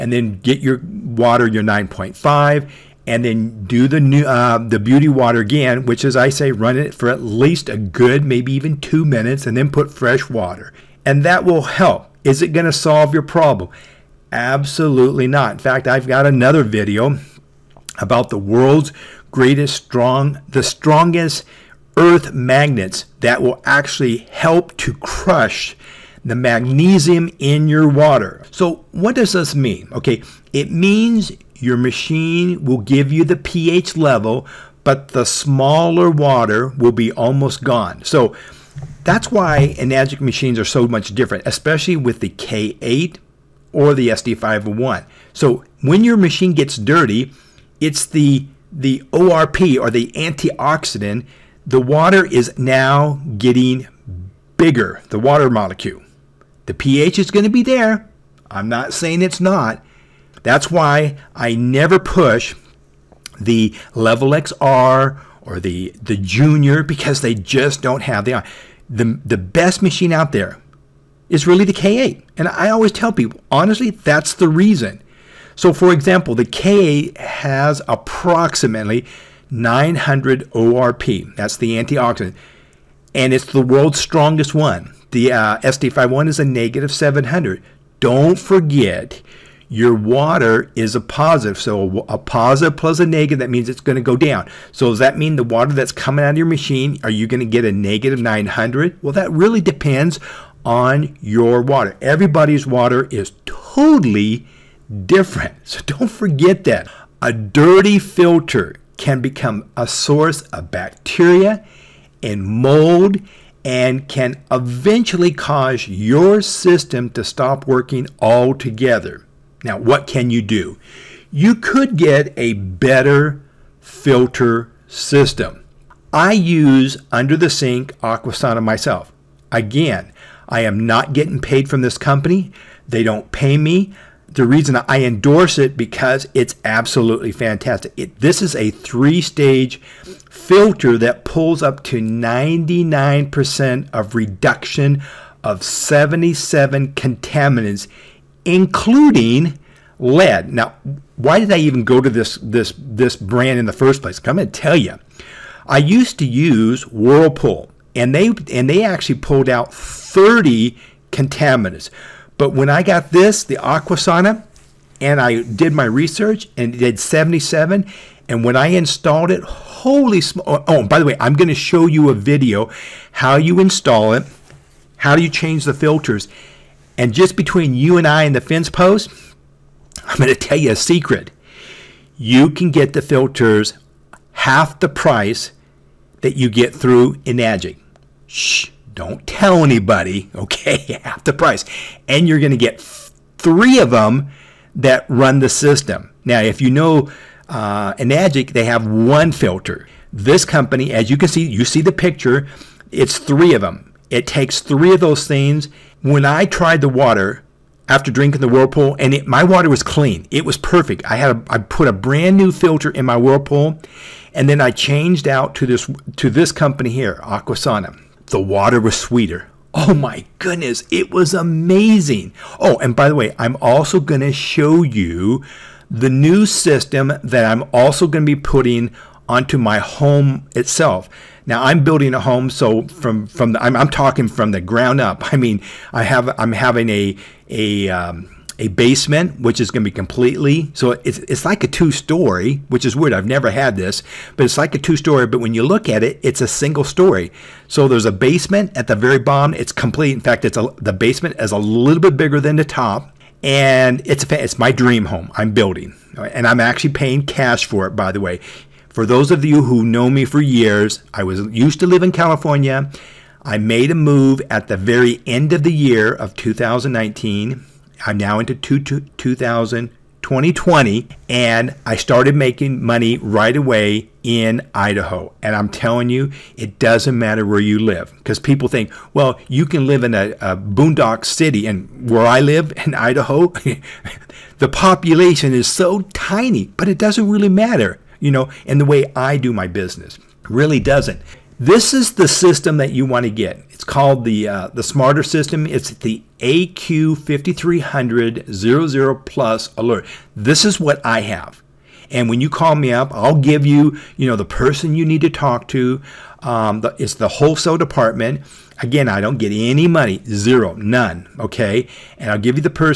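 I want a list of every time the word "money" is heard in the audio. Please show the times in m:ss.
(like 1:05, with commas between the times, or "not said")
4:32, 5:09.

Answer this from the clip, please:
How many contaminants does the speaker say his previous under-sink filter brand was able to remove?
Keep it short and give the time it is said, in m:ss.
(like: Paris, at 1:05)
30, at 2:39.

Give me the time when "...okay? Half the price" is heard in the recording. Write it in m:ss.
3:10.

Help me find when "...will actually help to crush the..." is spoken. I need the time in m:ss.
0:23.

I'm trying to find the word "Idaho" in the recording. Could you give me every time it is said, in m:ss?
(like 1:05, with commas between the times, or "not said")
4:34, 4:42.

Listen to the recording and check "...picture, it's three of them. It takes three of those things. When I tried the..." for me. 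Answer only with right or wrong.
right.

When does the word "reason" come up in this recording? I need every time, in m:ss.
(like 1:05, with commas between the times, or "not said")
1:14, 2:14.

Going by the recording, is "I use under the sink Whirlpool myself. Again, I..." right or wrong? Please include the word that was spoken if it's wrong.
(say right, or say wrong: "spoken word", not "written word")
wrong: "Aquasana", not "Whirlpool".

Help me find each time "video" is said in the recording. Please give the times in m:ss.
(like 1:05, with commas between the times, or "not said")
0:16, 2:52.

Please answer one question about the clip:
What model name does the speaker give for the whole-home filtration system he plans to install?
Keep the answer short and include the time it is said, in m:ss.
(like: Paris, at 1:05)
AQ5300 Plus Alert, at 4:56.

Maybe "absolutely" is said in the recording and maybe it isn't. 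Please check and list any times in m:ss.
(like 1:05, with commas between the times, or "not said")
0:14, 2:16.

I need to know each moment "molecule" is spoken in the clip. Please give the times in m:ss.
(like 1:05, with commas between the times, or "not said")
0:55.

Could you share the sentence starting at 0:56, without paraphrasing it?
The pH is going to be there.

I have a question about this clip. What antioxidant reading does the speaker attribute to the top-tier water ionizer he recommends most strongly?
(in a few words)
900.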